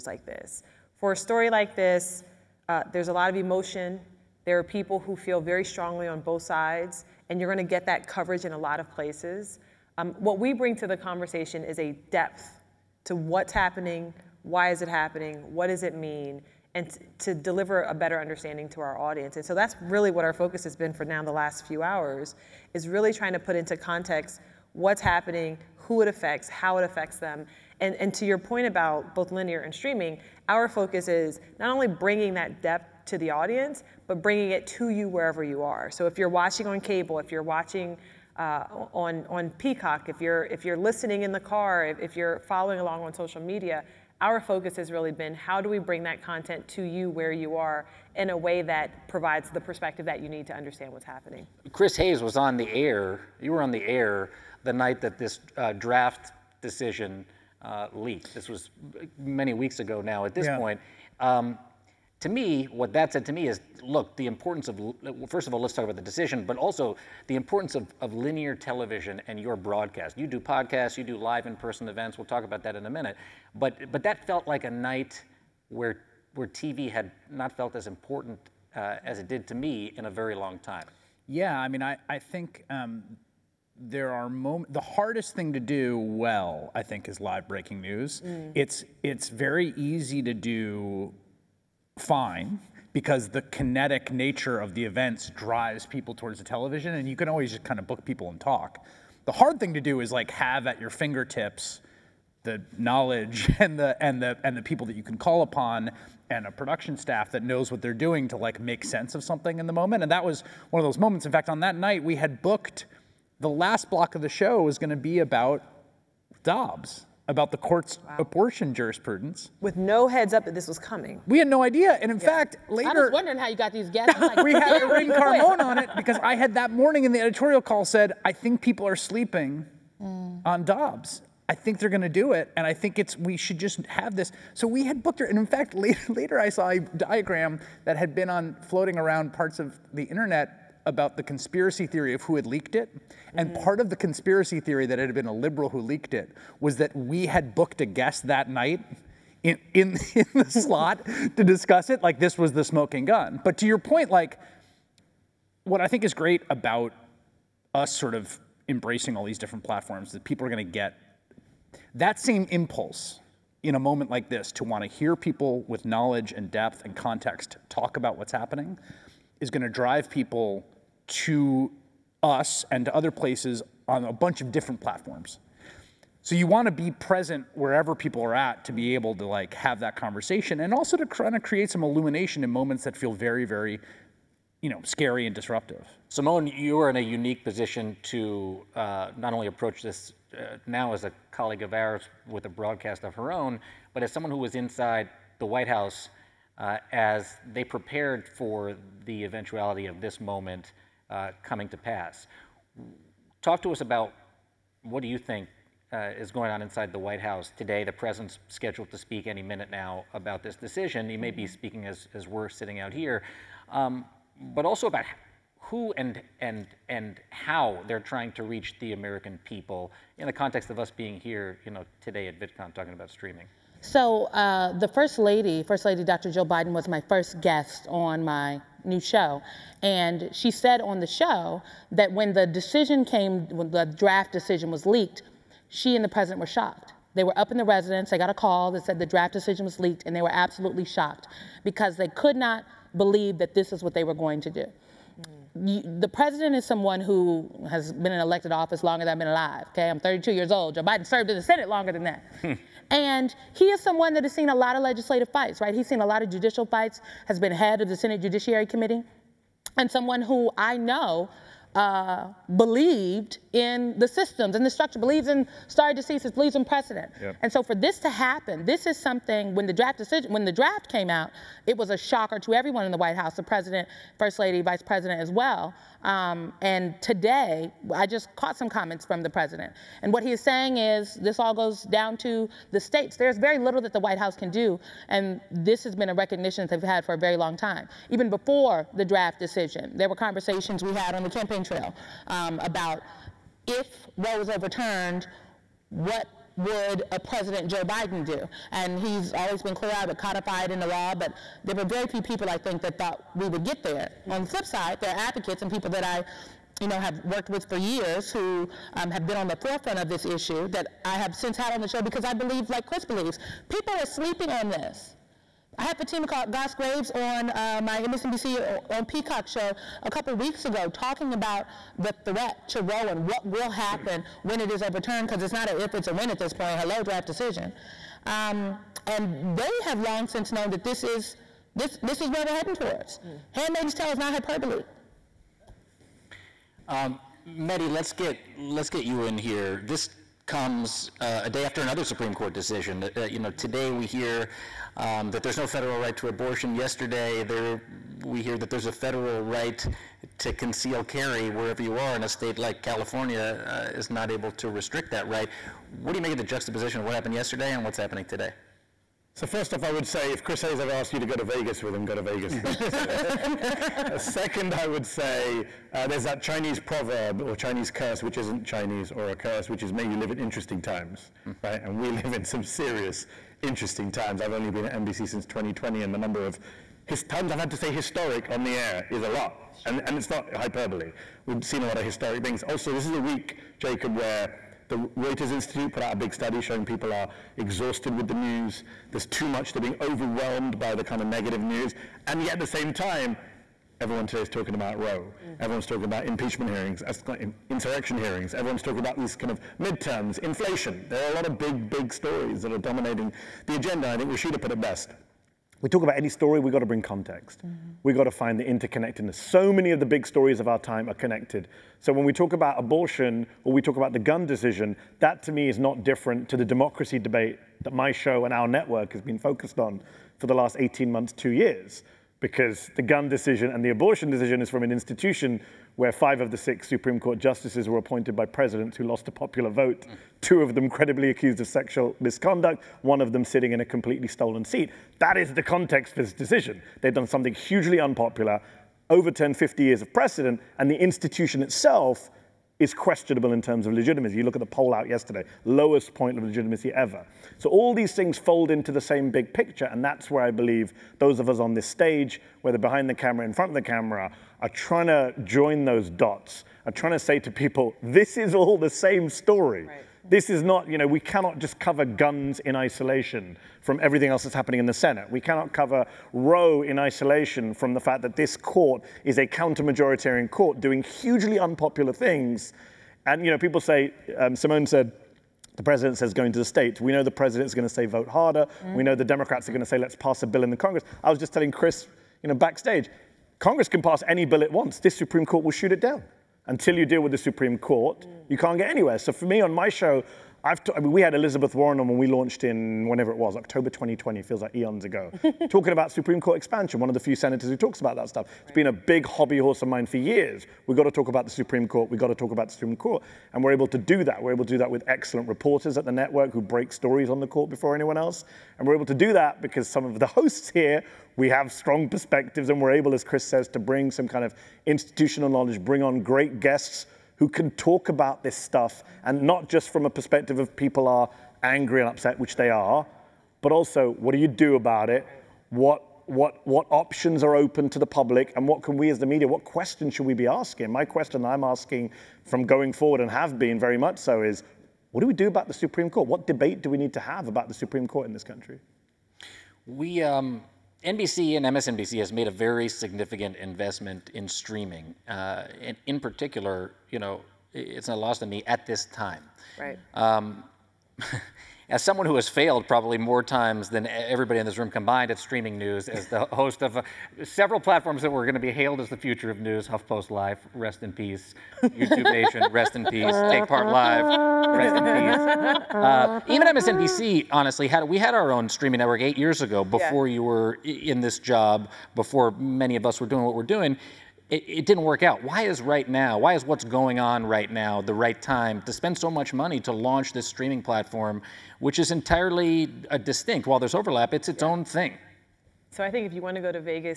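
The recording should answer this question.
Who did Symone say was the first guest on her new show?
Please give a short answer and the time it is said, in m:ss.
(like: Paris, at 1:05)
Jill Biden, at 3:46.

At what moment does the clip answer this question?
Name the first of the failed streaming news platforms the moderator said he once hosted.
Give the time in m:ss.
9:19.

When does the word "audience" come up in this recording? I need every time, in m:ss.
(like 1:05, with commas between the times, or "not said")
0:18, 0:33.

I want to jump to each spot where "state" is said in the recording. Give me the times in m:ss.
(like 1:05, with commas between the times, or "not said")
4:42, 5:52, 7:56.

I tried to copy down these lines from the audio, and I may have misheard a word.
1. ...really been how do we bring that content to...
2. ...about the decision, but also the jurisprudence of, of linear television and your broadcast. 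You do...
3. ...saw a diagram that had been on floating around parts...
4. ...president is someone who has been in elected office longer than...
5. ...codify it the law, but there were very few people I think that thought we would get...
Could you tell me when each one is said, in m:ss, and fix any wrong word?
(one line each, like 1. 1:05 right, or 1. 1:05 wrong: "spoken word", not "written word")
1. 0:44 right
2. 1:05 wrong: "importance", not "jurisprudence"
3. 2:16 right
4. 4:06 right
5. 5:00 right.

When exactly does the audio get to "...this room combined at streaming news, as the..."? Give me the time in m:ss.
9:14.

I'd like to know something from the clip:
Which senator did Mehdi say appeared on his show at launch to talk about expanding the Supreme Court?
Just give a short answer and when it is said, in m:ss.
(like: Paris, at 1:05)
Elizabeth Warren, at 8:11.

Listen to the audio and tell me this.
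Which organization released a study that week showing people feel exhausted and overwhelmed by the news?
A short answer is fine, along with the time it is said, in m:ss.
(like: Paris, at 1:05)
Reuters Institute, at 6:25.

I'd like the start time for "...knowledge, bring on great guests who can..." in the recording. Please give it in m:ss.
8:35.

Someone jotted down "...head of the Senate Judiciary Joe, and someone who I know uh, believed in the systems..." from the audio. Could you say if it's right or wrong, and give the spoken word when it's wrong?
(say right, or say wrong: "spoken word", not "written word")
wrong: "Committee", not "Joe".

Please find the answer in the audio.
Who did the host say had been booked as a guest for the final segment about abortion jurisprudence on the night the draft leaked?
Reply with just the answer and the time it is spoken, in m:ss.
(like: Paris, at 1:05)
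Irin Carmon, at 2:04.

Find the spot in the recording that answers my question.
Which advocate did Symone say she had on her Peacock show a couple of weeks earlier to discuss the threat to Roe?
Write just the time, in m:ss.
5:15.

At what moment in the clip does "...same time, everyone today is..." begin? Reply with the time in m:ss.
6:32.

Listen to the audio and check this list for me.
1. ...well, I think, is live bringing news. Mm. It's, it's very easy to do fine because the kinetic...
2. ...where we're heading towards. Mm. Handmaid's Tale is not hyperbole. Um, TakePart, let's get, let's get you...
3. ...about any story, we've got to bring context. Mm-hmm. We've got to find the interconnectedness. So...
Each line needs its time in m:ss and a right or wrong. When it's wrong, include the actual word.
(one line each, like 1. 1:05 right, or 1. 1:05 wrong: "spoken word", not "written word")
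1. 1:25 wrong: "breaking", not "bringing"
2. 5:32 wrong: "Mehdi", not "TakePart"
3. 6:46 right.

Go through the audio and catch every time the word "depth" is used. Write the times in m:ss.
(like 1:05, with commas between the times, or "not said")
0:12, 0:32, 2:46.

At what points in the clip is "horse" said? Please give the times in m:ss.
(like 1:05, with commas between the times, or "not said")
8:19.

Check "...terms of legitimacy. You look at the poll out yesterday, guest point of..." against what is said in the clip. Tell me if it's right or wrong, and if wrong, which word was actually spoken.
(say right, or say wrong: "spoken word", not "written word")
wrong: "lowest", not "guest".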